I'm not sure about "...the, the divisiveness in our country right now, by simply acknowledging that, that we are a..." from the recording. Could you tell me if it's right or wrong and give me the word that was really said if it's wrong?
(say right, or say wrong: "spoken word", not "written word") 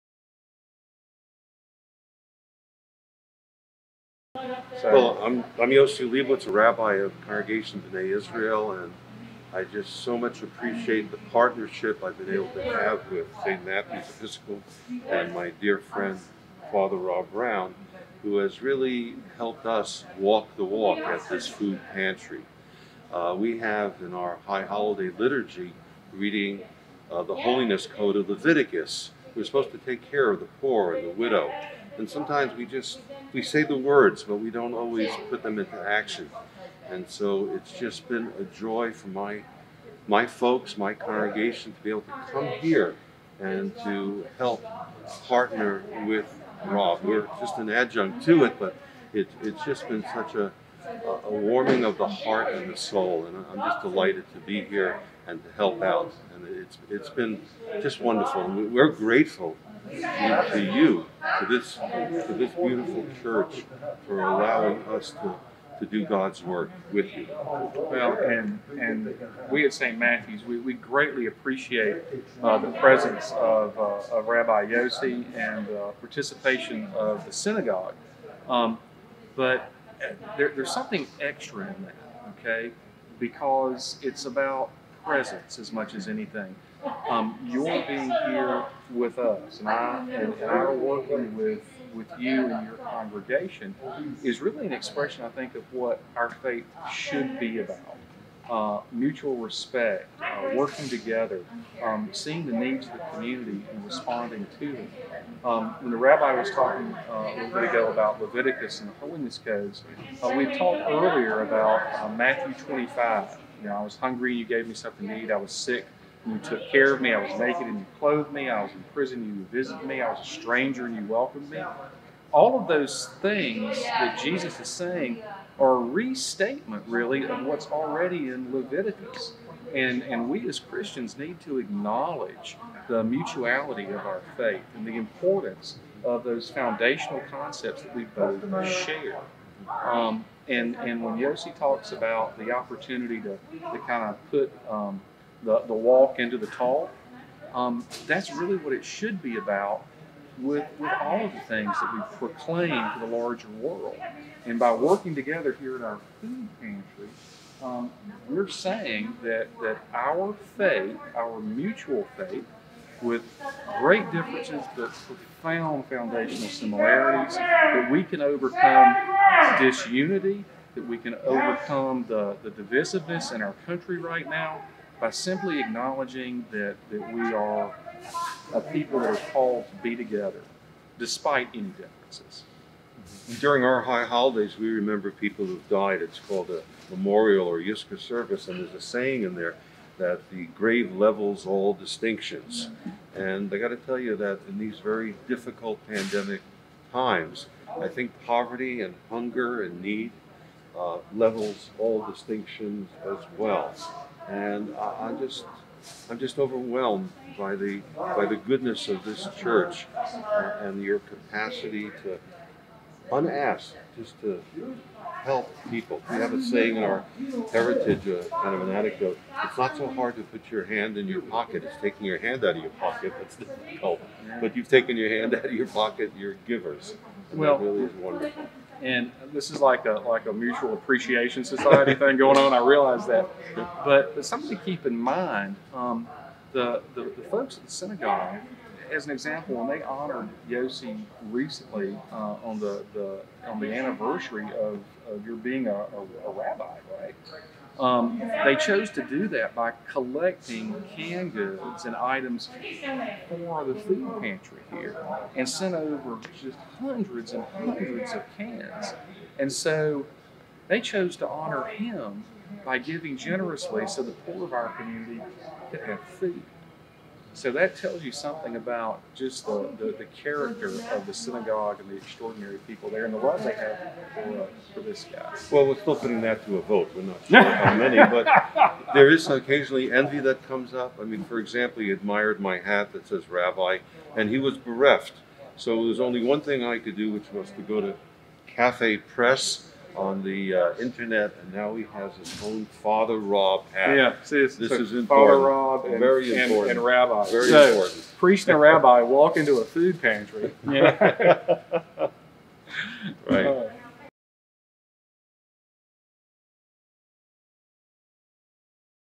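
right.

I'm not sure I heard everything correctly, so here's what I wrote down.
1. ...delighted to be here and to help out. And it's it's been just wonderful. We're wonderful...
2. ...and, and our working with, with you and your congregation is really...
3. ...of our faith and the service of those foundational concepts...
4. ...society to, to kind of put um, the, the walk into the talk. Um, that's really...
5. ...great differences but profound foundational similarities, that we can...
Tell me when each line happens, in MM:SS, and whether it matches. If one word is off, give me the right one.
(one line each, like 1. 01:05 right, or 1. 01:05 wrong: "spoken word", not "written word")
1. 00:53 wrong: "grateful", not "wonderful"
2. 01:30 right
3. 02:13 wrong: "importance", not "service"
4. 02:22 wrong: "opportunity", not "society"
5. 02:43 right.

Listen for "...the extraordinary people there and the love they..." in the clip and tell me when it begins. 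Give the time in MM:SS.
04:31.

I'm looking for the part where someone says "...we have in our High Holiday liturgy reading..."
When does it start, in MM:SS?
00:23.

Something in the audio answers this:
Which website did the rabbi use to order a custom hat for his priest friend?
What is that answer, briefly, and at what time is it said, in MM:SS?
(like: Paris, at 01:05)
Cafe Press, at 04:48.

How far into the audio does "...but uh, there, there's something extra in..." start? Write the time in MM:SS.
01:19.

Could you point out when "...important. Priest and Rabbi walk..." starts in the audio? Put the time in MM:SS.
04:57.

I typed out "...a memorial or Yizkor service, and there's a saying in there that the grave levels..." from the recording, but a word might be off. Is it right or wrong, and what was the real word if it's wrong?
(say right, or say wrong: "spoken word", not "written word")
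right.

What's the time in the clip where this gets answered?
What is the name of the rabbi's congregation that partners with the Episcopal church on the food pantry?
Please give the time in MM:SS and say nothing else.
00:07.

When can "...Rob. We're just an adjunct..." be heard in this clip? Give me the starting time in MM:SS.
00:46.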